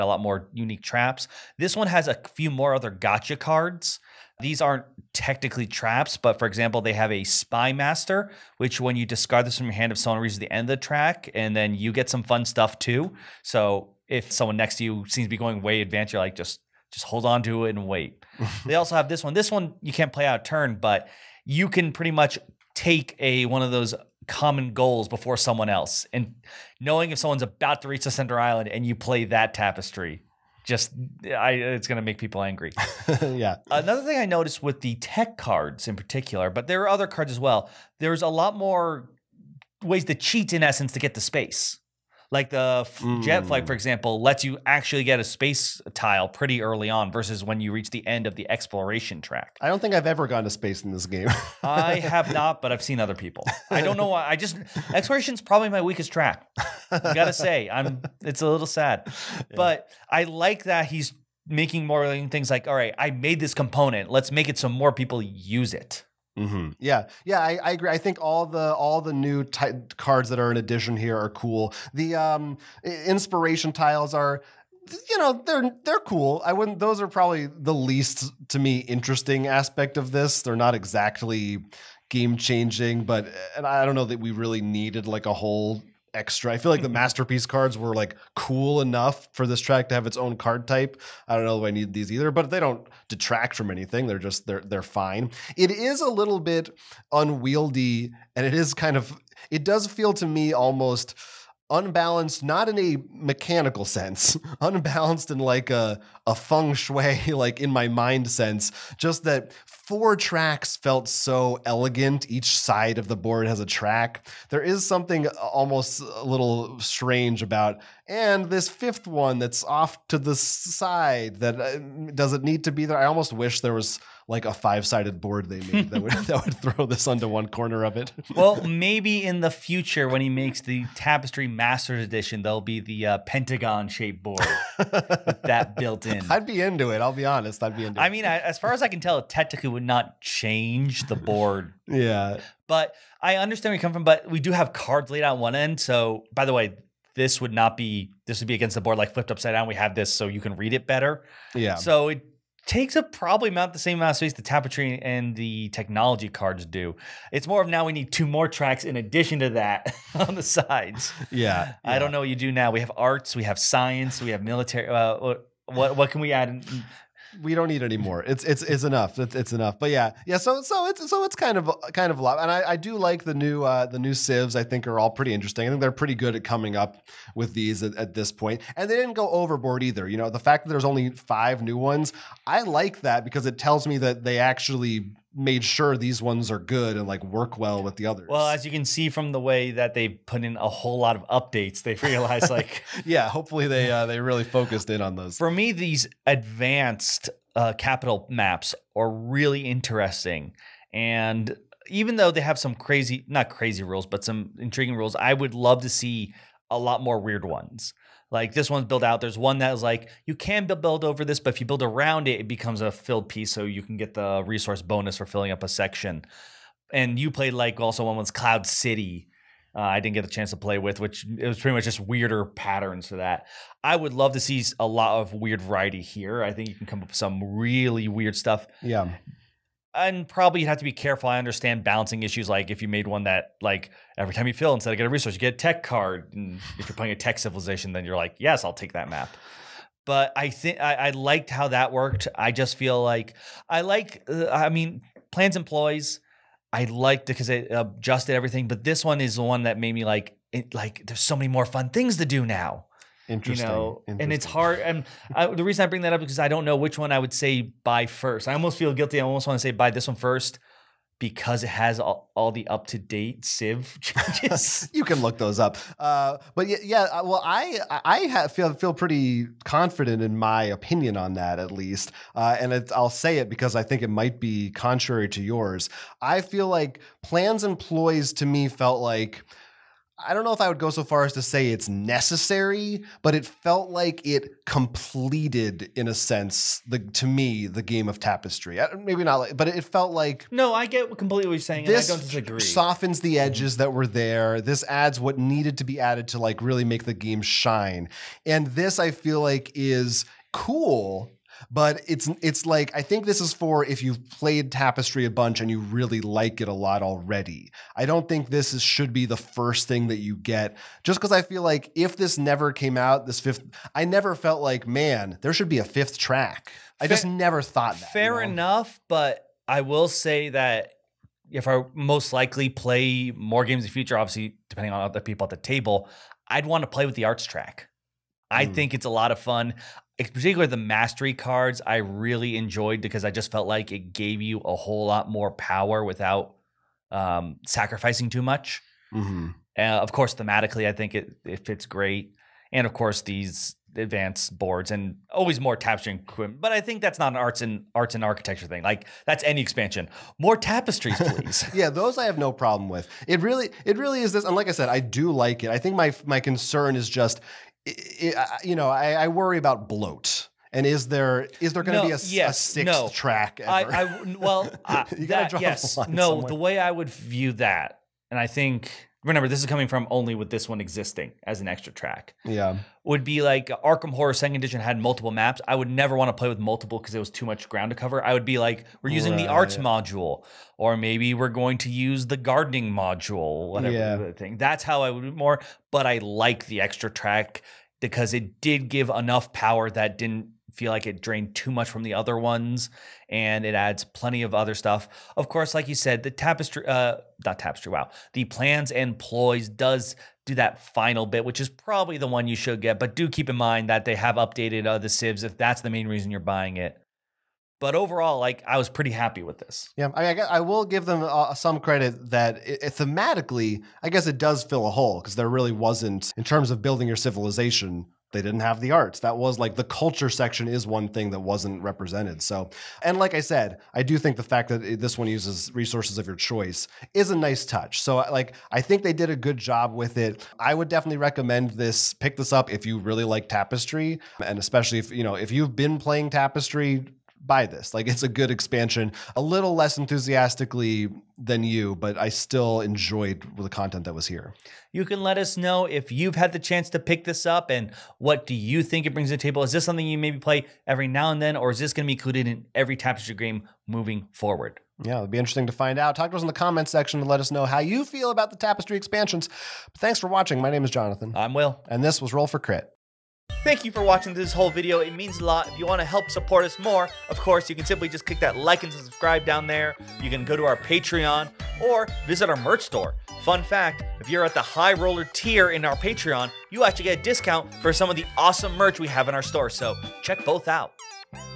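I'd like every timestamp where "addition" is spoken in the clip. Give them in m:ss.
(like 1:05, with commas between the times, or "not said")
1:10, 2:38.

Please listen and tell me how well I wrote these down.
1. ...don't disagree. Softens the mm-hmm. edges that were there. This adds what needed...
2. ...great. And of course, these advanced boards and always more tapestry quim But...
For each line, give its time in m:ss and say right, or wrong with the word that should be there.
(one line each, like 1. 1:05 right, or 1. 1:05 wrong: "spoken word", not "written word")
1. 4:52 right
2. 5:41 right.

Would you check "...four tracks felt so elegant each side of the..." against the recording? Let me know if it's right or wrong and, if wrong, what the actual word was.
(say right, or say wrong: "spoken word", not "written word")
right.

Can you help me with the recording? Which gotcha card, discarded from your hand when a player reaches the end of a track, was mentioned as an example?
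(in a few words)
Spy master.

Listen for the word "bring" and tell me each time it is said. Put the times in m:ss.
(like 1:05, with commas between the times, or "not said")
4:15, 7:29.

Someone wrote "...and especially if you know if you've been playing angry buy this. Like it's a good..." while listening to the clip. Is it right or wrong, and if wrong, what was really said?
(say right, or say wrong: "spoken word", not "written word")
wrong: "tapestry", not "angry".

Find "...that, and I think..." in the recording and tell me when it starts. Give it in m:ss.
6:07.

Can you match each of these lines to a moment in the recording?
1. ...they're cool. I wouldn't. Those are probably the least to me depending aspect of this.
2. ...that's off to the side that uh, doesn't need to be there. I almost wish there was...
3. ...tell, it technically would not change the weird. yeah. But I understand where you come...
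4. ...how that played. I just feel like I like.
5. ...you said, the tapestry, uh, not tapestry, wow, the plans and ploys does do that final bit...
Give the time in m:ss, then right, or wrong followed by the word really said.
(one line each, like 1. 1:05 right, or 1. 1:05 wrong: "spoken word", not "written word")
1. 1:15 wrong: "interesting", not "depending"
2. 1:59 right
3. 2:18 wrong: "board", not "weird"
4. 4:01 wrong: "worked", not "played"
5. 6:35 right.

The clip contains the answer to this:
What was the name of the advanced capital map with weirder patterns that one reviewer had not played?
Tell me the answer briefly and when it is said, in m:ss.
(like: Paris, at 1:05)
Cloud City, at 3:38.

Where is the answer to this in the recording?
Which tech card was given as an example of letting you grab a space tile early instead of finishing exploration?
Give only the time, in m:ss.
0:43.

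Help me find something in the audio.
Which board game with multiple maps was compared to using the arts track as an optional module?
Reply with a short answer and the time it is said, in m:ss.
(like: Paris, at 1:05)
Arkham Horror Second Edition, at 6:13.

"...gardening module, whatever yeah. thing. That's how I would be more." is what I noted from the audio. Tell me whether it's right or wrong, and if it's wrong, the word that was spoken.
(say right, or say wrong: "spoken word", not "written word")
right.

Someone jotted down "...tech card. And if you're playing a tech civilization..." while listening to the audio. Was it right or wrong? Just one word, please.
right.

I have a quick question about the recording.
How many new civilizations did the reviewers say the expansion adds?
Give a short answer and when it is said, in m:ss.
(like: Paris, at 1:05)
5, at 3:01.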